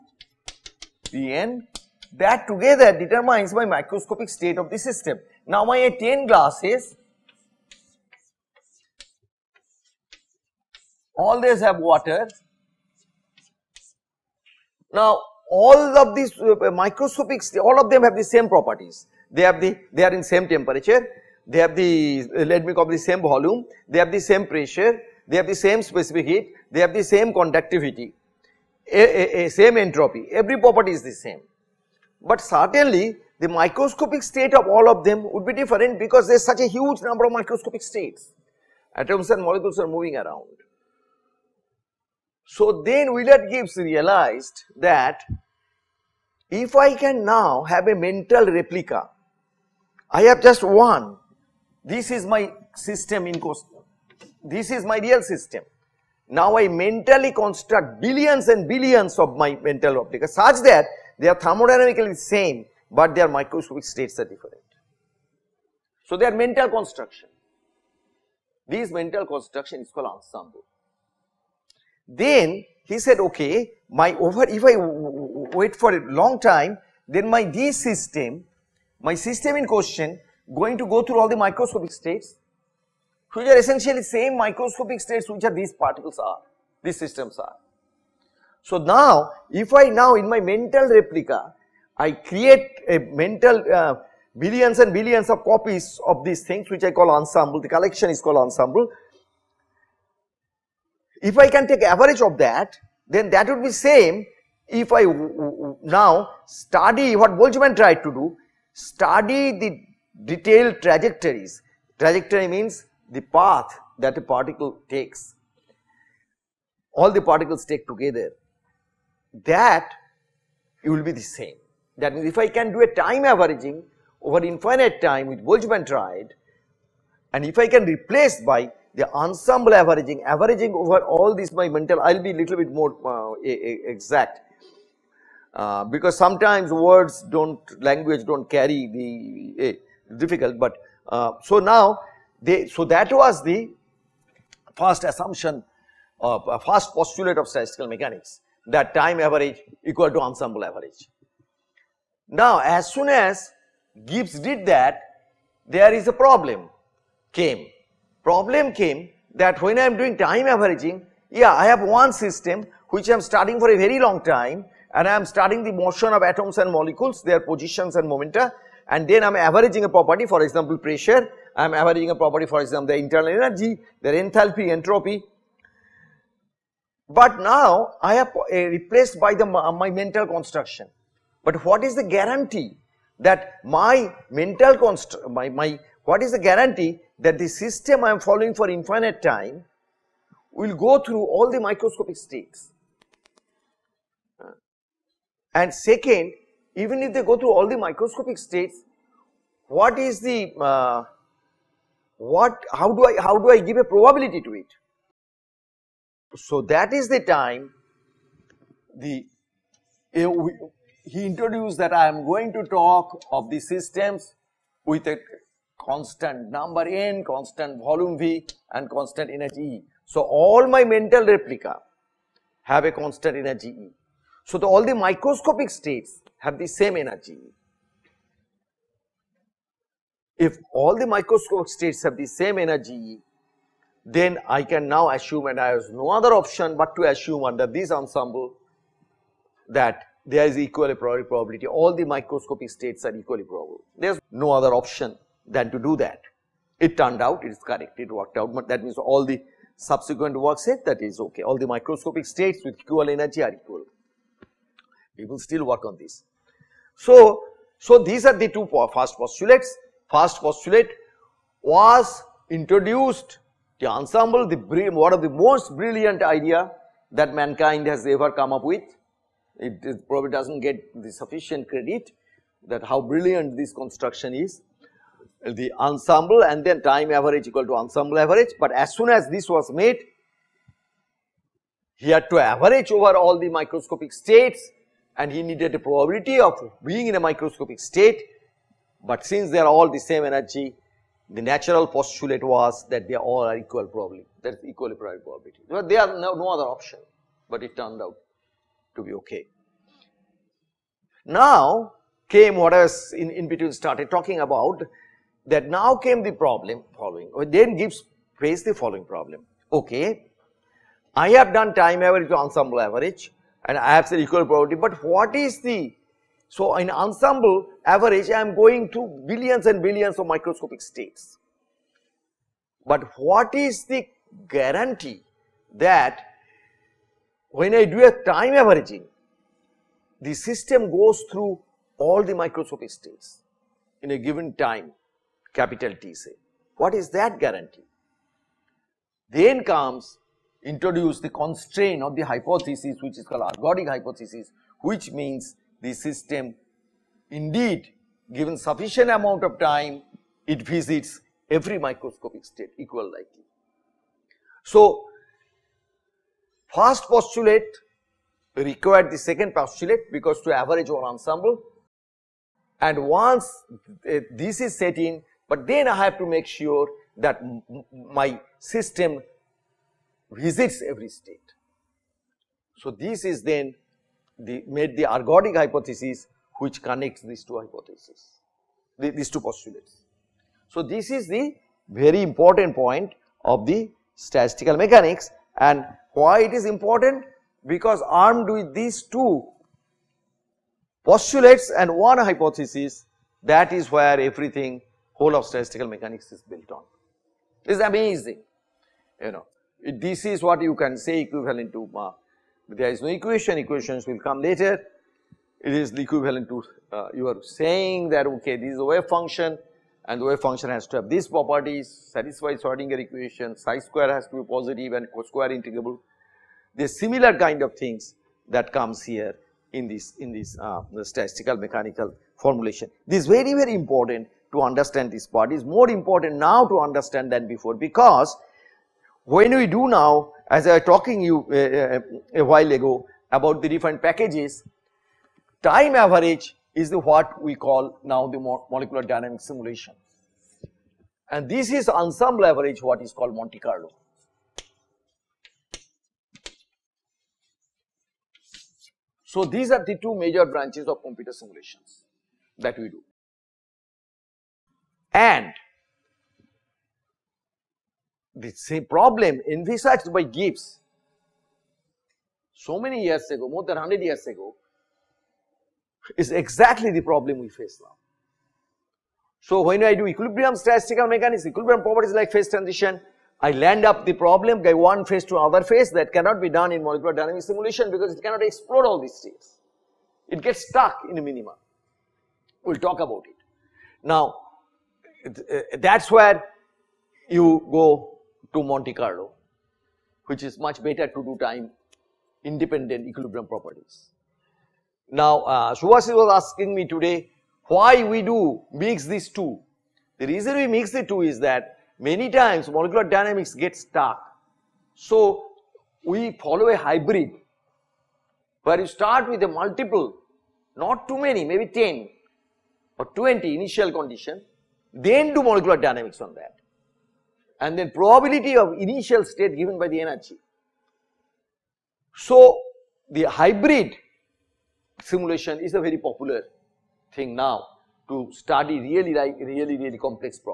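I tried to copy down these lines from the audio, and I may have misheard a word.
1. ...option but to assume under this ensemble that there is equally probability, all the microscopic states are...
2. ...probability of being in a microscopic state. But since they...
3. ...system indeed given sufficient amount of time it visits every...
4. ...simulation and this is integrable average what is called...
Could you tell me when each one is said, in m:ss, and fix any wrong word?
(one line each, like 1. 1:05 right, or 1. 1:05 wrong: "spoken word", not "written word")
1. 3:56 right
2. 4:45 right
3. 5:45 right
4. 7:19 wrong: "ensemble", not "integrable".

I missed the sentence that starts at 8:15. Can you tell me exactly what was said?
Now, uh, was asking me today why we do mix these two.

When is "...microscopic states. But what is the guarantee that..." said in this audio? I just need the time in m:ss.
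5:20.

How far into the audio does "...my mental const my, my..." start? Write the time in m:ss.
3:03.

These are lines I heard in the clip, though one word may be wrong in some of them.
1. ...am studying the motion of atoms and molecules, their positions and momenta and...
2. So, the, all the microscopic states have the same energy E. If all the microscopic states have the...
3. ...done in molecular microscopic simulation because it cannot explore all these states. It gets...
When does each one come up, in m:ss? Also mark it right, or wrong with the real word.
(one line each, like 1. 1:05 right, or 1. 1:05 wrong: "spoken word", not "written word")
1. 2:45 right
2. 3:44 right
3. 7:56 wrong: "dynamic", not "microscopic".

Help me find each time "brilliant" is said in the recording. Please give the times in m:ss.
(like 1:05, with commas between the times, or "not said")
4:25, 4:33.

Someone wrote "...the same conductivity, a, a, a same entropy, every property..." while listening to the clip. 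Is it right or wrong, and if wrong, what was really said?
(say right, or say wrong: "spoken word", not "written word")
right.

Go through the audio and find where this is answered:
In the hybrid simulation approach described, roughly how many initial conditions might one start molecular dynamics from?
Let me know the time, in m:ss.
8:31.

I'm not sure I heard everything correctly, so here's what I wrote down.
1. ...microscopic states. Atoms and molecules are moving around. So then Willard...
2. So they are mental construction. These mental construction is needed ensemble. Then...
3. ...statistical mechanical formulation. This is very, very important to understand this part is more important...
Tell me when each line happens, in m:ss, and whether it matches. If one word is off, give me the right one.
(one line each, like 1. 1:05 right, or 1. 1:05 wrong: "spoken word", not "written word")
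1. 0:37 right
2. 1:06 wrong: "called", not "needed"
3. 7:01 right.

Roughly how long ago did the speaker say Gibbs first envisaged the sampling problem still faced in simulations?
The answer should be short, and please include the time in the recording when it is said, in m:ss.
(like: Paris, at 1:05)
More than 100 years, at 7:43.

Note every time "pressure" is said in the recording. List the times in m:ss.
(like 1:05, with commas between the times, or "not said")
0:24, 2:50.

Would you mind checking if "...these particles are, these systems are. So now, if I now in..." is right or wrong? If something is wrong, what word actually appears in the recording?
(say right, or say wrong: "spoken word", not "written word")
right.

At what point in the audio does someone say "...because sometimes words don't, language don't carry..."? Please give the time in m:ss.
2:15.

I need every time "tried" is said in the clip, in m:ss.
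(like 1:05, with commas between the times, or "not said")
1:47, 2:05.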